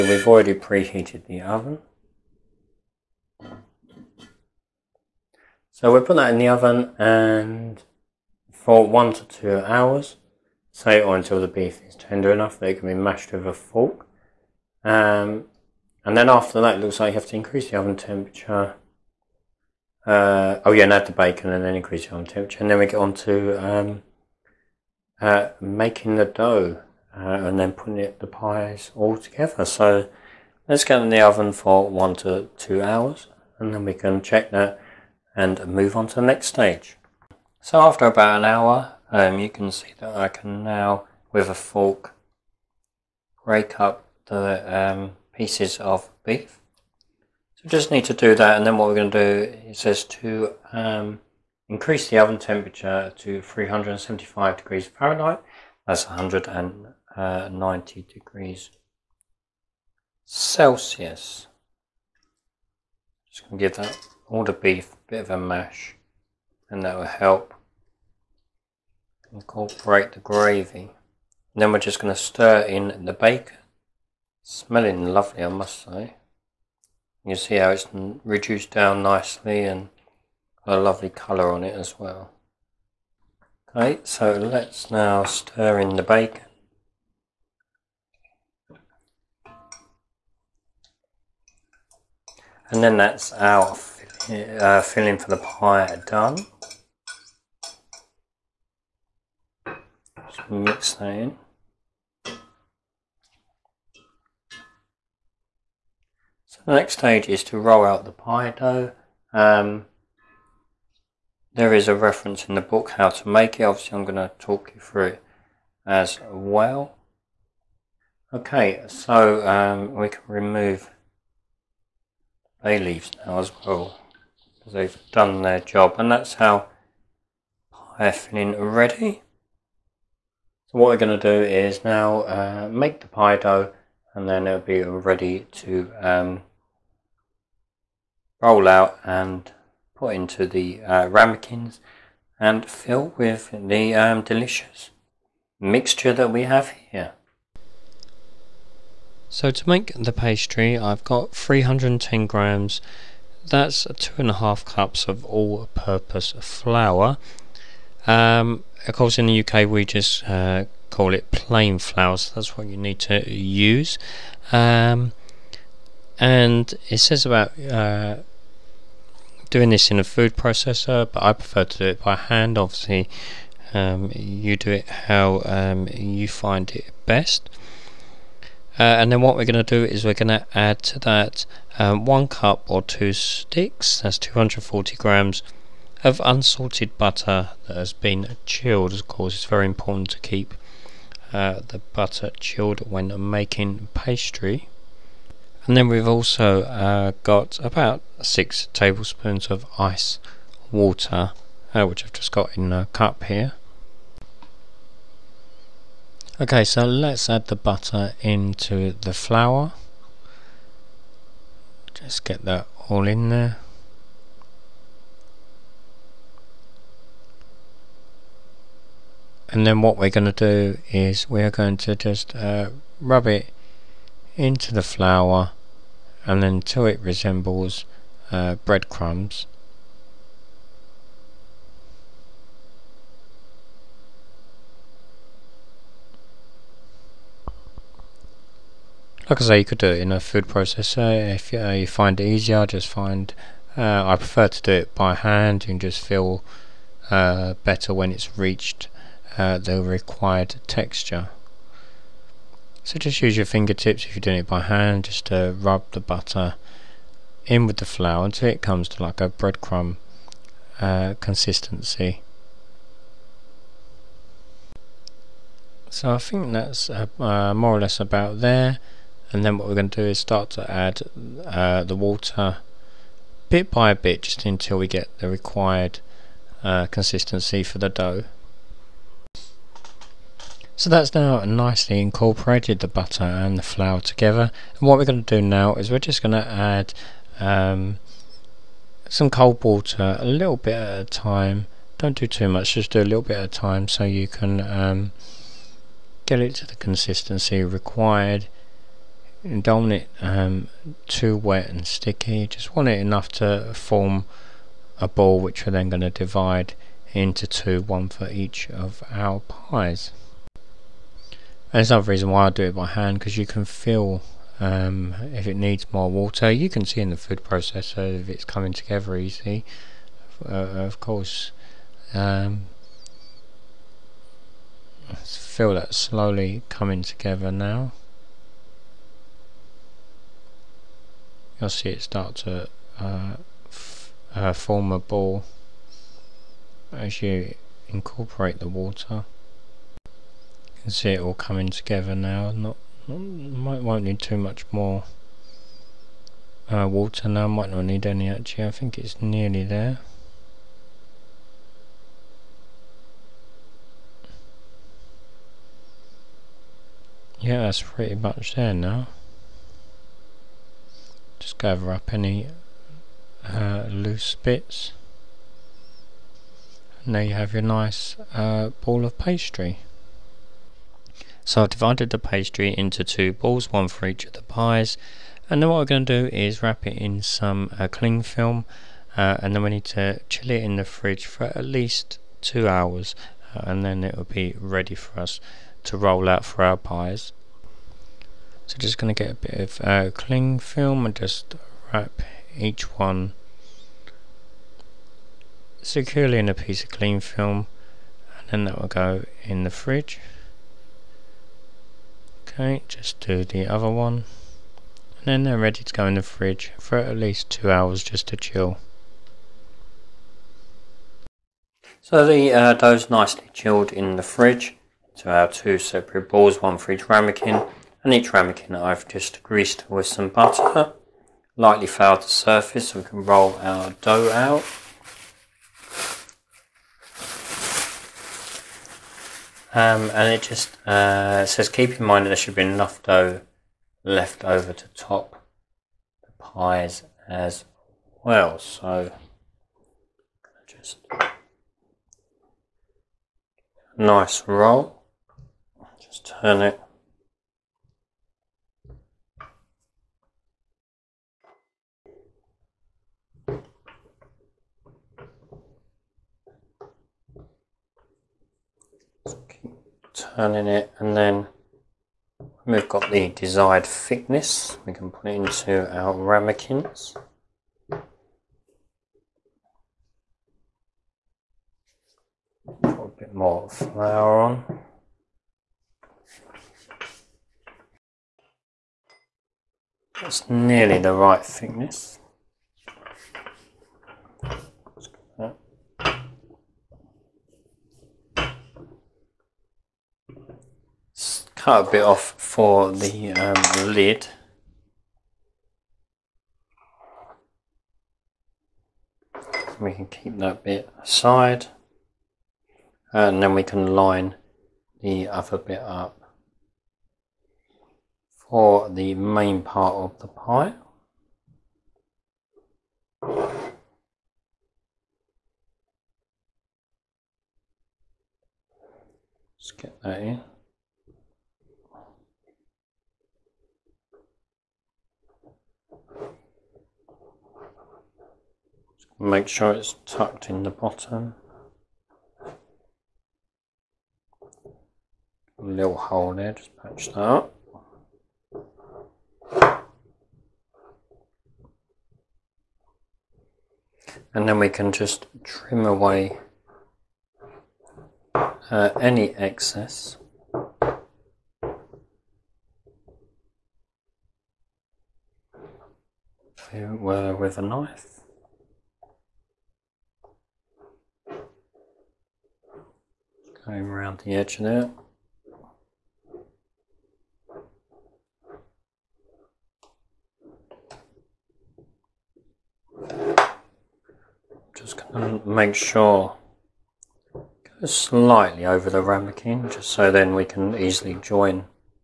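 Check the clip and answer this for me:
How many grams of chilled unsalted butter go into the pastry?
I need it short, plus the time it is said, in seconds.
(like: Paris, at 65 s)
240 grams, at 184 s.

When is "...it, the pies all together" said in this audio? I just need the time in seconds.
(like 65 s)
27 s.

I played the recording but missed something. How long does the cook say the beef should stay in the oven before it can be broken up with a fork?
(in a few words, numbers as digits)
1 to 2 hours.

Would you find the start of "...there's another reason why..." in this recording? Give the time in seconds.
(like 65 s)
311 s.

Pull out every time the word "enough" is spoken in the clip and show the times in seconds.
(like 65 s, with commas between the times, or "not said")
12 s, 303 s, 432 s.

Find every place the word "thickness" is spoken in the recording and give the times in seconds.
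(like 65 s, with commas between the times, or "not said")
463 s, 481 s.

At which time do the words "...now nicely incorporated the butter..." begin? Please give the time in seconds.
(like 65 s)
281 s.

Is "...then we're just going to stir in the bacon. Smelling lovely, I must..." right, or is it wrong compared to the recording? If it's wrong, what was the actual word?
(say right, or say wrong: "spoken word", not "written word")
right.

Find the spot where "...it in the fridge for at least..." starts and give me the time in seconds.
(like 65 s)
380 s.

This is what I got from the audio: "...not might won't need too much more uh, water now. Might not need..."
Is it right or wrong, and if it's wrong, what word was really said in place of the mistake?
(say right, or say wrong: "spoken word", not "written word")
right.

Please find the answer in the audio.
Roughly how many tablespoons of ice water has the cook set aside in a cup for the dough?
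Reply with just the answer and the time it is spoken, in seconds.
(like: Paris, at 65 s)
6, at 198 s.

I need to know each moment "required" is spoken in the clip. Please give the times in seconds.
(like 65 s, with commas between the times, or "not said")
249 s, 275 s, 297 s.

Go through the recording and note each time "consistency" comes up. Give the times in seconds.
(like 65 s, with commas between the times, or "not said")
261 s, 276 s, 296 s.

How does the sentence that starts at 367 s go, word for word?
And there you have your nice uh, ball of pastry.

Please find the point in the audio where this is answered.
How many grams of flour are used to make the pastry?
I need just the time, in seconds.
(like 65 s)
151 s.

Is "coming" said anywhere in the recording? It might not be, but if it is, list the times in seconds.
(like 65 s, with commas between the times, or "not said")
318 s, 326 s, 341 s.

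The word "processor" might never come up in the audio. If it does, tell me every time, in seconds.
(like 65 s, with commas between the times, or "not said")
170 s, 240 s, 317 s.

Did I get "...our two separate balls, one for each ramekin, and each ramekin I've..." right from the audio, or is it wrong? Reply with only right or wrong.
right.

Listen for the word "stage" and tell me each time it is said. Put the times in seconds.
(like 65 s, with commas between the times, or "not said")
36 s, 106 s.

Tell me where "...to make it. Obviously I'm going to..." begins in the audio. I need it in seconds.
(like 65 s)
113 s.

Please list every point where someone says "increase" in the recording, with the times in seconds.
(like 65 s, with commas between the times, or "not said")
17 s, 21 s, 51 s.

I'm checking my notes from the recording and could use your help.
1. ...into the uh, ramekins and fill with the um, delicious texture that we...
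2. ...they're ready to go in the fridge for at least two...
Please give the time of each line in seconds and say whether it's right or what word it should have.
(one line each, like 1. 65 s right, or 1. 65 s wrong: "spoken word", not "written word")
1. 140 s wrong: "mixture", not "texture"
2. 405 s right.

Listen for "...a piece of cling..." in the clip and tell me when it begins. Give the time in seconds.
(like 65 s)
396 s.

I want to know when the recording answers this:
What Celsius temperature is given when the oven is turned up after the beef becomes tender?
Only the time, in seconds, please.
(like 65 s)
56 s.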